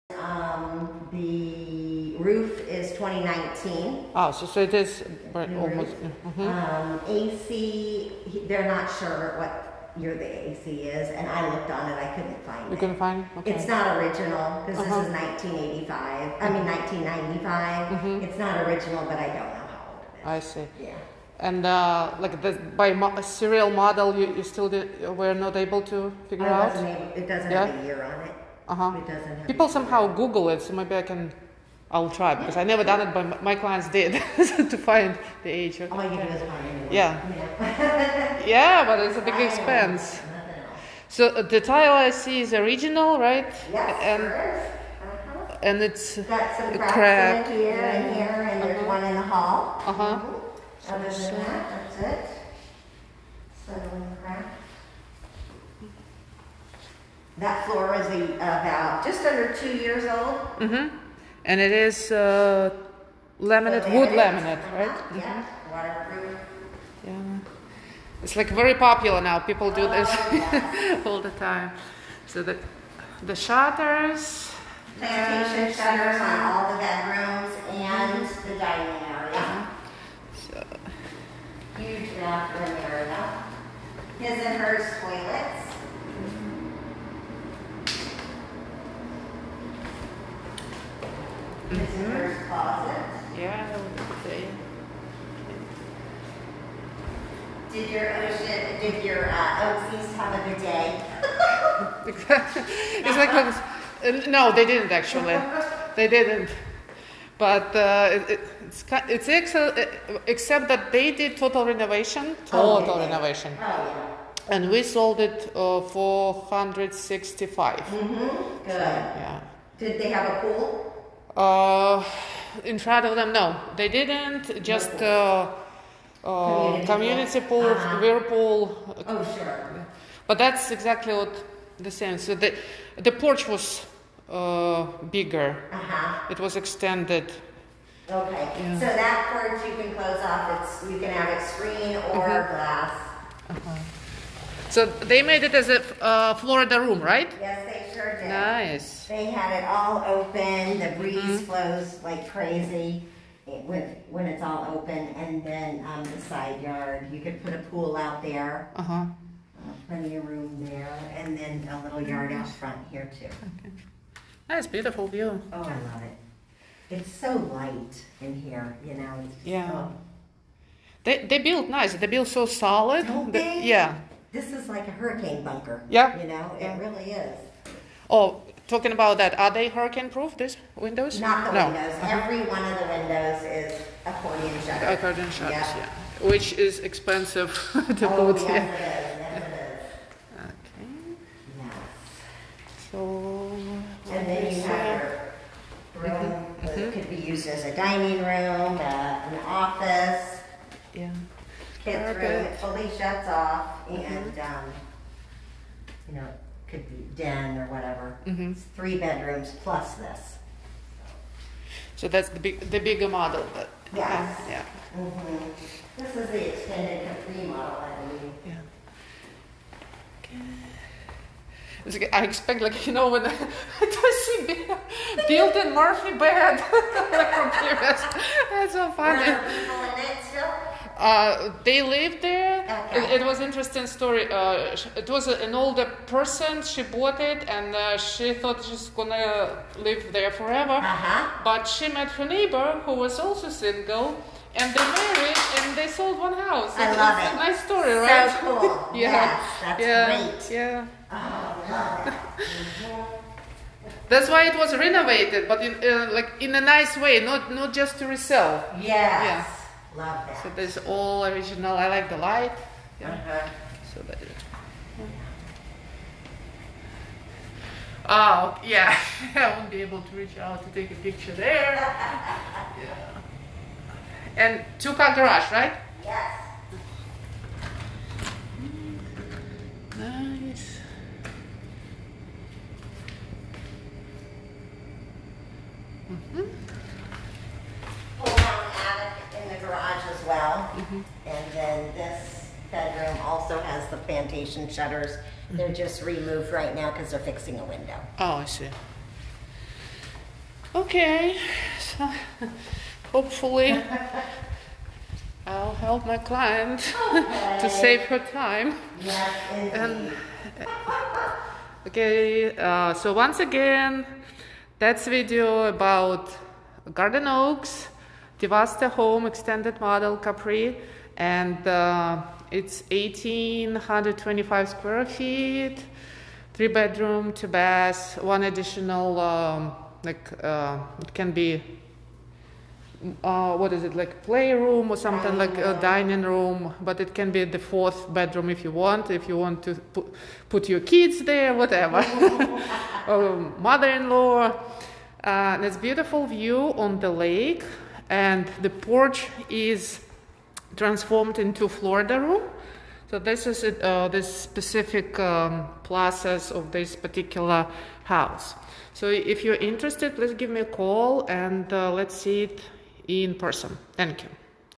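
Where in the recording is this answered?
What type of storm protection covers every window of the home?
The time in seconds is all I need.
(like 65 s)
184 s.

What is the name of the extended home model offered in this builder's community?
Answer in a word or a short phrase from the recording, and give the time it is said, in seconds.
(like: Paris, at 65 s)
Capri, at 320 s.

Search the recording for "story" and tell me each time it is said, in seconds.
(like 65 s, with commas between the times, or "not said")
233 s, 247 s.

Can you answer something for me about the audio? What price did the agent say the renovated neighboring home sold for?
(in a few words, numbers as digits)
165.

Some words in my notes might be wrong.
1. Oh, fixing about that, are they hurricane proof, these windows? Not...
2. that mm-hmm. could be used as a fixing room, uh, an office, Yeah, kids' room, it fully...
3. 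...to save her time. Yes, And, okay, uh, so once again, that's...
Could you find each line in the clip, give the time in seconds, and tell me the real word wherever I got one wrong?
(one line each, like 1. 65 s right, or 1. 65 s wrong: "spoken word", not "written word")
1. 178 s wrong: "talking", not "fixing"
2. 196 s wrong: "dining", not "fixing"
3. 307 s right.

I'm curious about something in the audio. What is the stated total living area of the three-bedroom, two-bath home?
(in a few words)
1,825 square feet.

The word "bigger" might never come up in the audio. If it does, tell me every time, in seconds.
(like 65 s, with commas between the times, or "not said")
135 s, 212 s.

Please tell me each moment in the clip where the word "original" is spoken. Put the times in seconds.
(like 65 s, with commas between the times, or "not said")
13 s, 18 s, 42 s, 261 s.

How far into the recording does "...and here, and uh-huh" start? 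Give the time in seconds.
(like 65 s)
47 s.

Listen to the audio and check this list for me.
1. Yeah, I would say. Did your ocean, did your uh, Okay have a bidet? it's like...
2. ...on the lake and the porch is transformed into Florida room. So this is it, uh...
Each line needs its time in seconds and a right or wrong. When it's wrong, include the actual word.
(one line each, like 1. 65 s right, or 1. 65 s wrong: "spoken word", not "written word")
1. 93 s wrong: "Oaksies", not "Okay"
2. 346 s right.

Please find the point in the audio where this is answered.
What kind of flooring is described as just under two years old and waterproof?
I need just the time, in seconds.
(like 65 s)
63 s.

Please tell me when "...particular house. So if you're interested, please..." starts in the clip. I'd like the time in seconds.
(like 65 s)
356 s.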